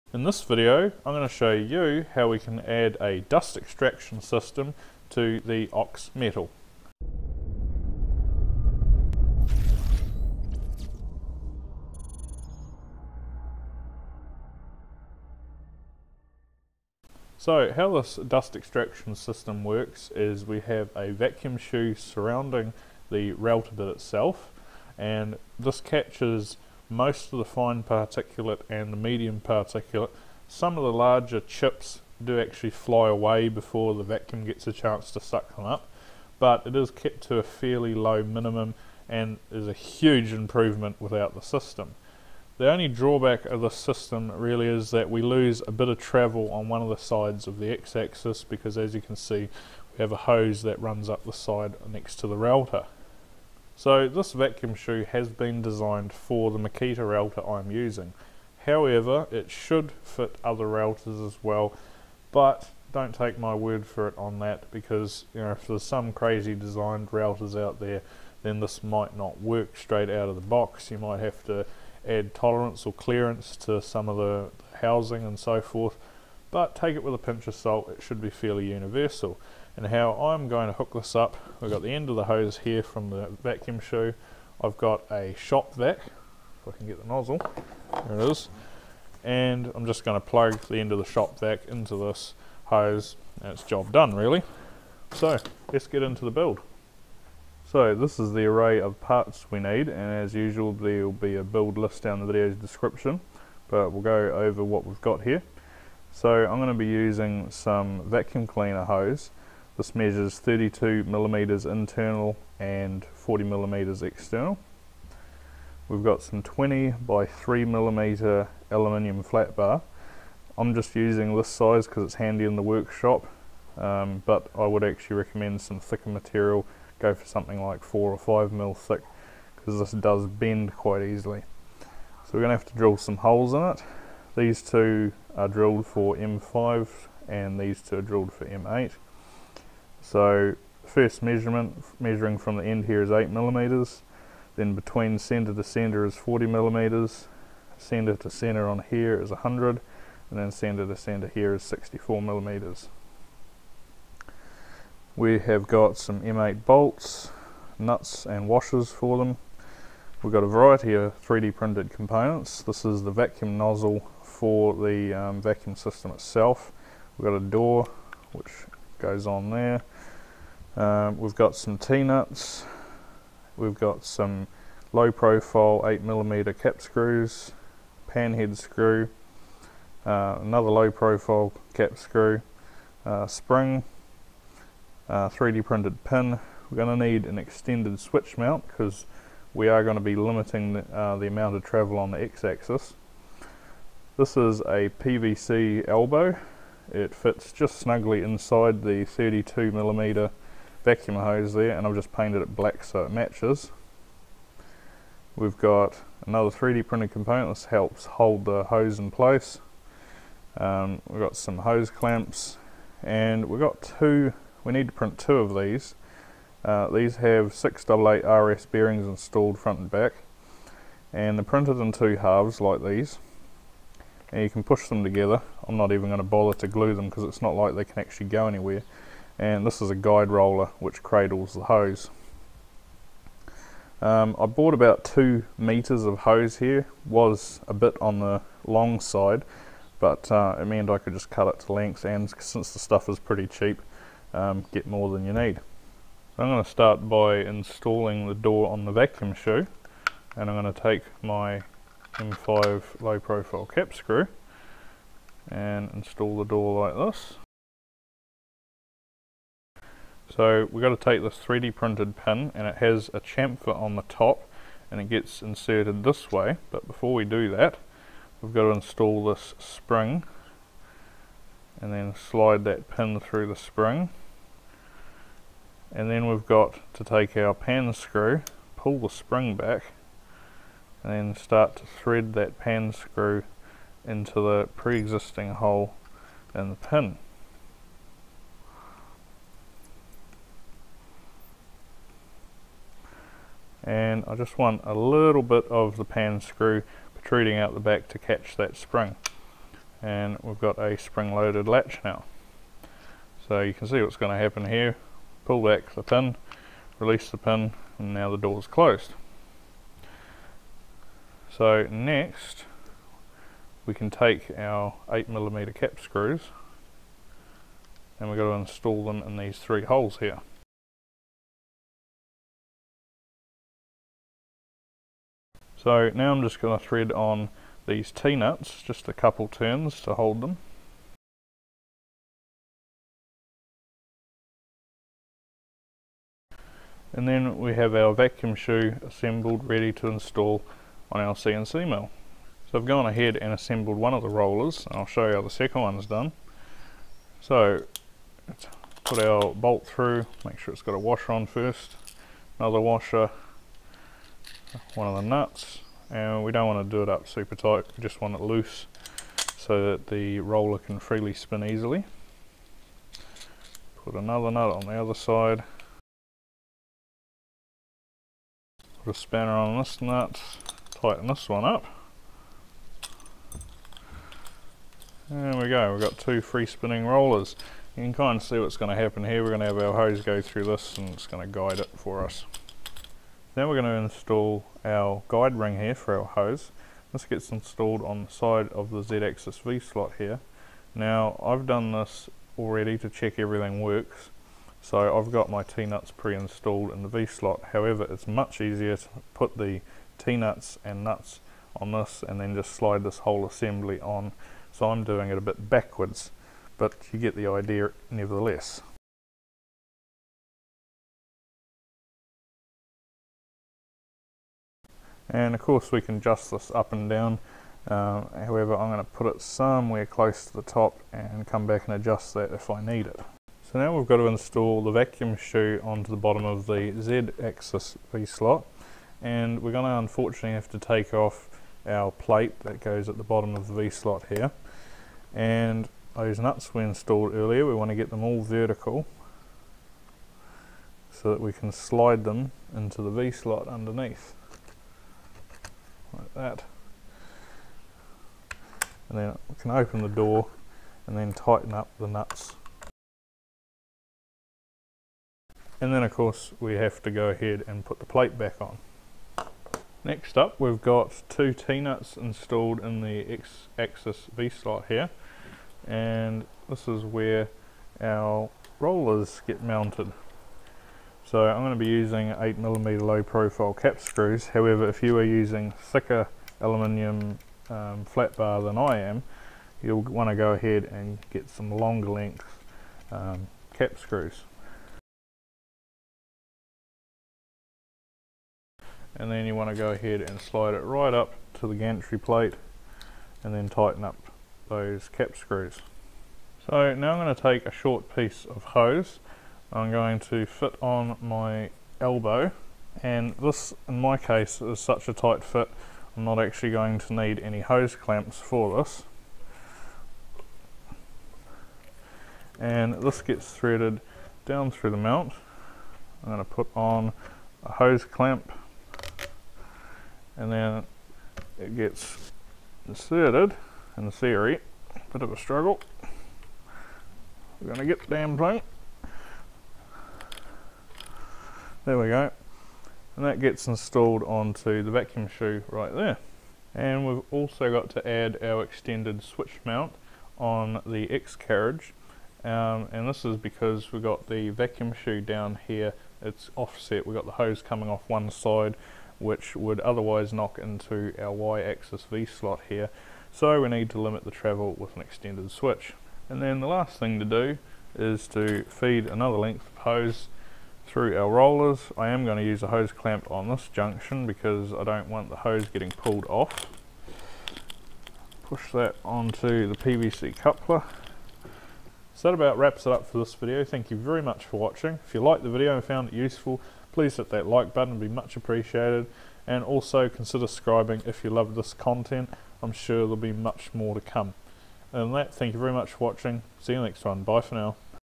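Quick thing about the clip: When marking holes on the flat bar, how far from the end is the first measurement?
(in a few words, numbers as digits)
8 millimeters.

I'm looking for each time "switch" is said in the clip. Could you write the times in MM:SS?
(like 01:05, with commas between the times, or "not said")
03:07, 08:59, 09:15.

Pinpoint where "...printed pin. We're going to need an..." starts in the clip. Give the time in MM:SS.
03:05.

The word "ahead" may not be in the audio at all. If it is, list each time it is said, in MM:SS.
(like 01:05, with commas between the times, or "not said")
05:43, 07:37, 08:00, 08:09.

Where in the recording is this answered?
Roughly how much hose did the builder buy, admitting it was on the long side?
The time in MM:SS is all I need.
03:55.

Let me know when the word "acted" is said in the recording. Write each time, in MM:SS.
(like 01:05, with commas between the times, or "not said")
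not said.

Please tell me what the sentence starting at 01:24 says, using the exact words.
I've got a shop vac, if I can get the nozzle, there it is.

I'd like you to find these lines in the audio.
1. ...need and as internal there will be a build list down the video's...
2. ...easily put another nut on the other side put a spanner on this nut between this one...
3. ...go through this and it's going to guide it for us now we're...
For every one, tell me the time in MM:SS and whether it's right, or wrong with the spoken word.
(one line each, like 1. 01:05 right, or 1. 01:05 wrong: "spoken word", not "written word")
1. 01:39 wrong: "usual", not "internal"
2. 06:01 wrong: "tighten", not "between"
3. 06:20 right.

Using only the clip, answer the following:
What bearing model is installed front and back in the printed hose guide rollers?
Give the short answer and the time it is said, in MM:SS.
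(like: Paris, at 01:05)
688 RS, at 03:37.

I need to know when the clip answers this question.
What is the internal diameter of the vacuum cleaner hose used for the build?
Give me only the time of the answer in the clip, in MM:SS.
01:50.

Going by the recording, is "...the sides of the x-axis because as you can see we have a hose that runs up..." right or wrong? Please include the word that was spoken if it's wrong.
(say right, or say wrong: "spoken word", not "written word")
right.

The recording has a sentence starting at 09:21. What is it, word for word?
I am going to use a hose clamp on this junction because I don't want the hose getting pulled off.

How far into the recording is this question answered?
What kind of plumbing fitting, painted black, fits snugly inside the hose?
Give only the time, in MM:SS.
03:15.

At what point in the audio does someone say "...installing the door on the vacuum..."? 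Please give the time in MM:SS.
04:07.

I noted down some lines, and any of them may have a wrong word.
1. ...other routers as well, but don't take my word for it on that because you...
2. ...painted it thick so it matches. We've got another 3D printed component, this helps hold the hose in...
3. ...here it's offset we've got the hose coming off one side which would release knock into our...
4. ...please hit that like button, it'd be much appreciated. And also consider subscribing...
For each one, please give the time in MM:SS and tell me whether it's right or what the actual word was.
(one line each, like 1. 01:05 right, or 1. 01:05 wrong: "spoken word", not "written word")
1. 01:00 right
2. 03:22 wrong: "black", not "thick"
3. 09:05 wrong: "otherwise", not "release"
4. 09:36 right.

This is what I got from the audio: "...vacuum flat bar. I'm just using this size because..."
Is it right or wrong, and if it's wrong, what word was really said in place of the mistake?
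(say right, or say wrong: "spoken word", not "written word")
wrong: "aluminium", not "vacuum".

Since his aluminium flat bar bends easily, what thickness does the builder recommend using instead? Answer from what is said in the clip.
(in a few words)
4 or 5 mil.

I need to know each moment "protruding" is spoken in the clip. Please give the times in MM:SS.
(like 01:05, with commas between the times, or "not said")
04:57.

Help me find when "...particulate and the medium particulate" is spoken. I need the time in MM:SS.
00:27.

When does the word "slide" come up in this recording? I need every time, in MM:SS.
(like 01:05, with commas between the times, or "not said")
04:32, 06:42, 07:21, 08:10.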